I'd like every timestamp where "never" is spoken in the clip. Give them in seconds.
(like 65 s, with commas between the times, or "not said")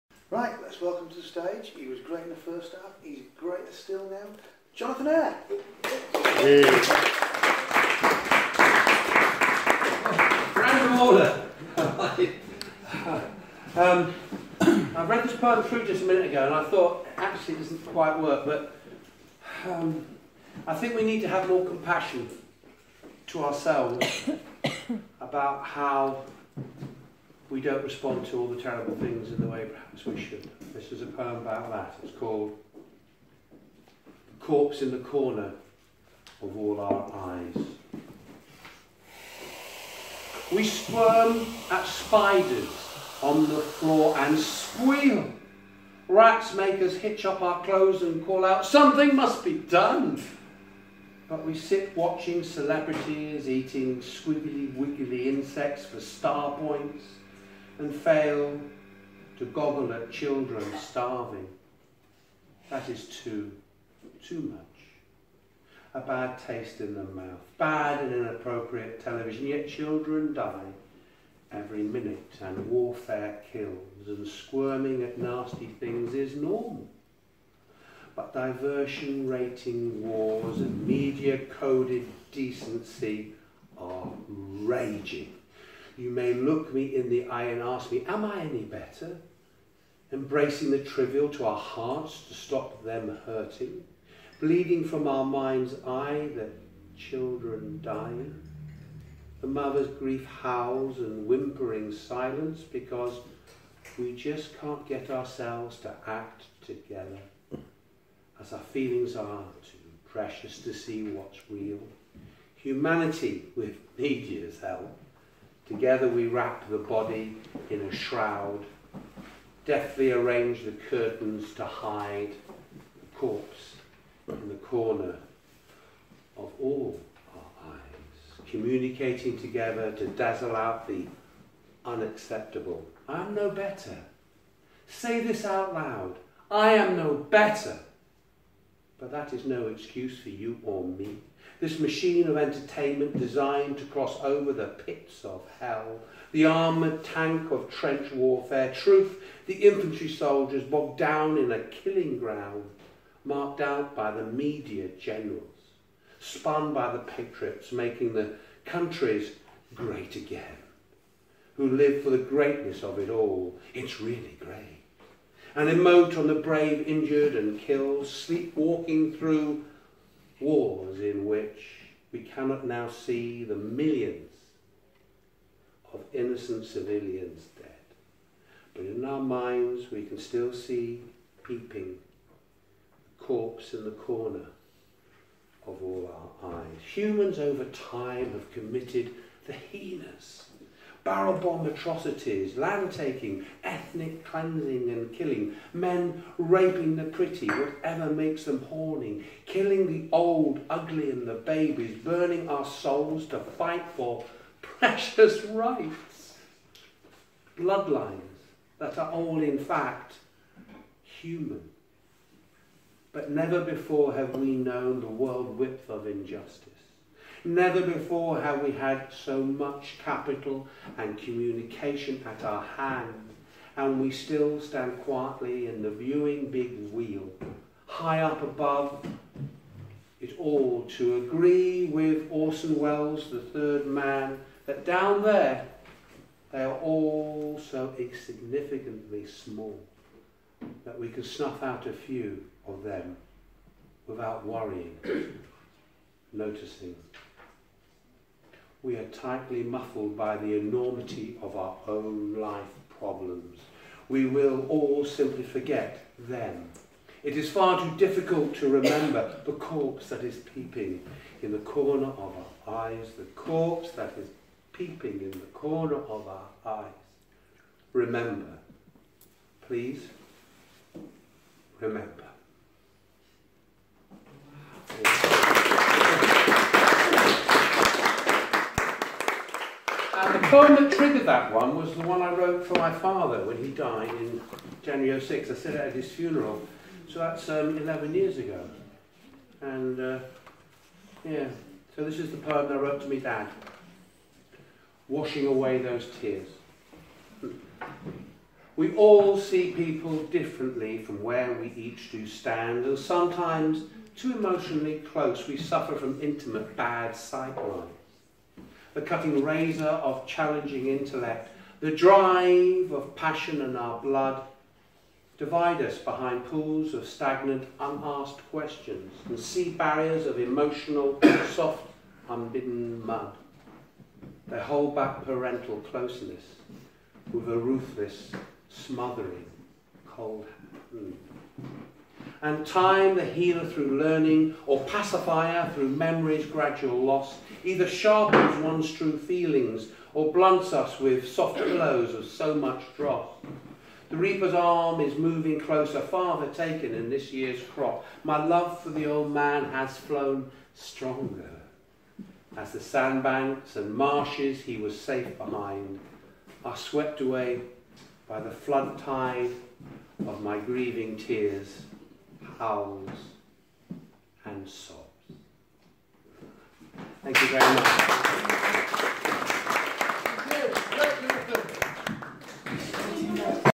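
213 s, 217 s.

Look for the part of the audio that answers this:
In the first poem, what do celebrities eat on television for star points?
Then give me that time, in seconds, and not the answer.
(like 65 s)
53 s.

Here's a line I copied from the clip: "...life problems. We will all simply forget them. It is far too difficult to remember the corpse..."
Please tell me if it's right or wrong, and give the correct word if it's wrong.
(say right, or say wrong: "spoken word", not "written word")
right.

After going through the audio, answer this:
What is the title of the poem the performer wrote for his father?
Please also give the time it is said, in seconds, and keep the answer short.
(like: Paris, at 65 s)
Washing away those tears, at 295 s.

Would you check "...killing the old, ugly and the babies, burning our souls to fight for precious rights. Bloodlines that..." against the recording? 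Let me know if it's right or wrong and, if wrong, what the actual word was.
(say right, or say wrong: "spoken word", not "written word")
right.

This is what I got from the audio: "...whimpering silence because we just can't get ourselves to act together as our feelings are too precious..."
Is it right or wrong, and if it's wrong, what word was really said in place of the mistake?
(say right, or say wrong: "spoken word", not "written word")
right.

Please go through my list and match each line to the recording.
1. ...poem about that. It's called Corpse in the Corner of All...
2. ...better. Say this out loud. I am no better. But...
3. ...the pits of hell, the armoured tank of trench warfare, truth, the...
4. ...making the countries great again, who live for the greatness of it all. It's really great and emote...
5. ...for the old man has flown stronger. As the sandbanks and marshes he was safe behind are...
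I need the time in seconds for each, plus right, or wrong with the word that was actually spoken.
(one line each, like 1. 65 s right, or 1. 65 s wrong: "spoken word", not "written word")
1. 31 s right
2. 133 s right
3. 144 s right
4. 157 s right
5. 348 s right.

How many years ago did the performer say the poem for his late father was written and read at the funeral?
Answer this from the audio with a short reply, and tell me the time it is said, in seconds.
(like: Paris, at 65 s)
11, at 287 s.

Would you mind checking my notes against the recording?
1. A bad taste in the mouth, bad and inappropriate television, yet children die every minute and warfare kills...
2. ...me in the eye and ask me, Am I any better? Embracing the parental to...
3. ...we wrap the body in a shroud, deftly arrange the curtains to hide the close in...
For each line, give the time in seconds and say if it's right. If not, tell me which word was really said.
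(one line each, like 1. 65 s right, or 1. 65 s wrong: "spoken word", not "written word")
1. 65 s right
2. 86 s wrong: "trivial", not "parental"
3. 116 s wrong: "corpse", not "close".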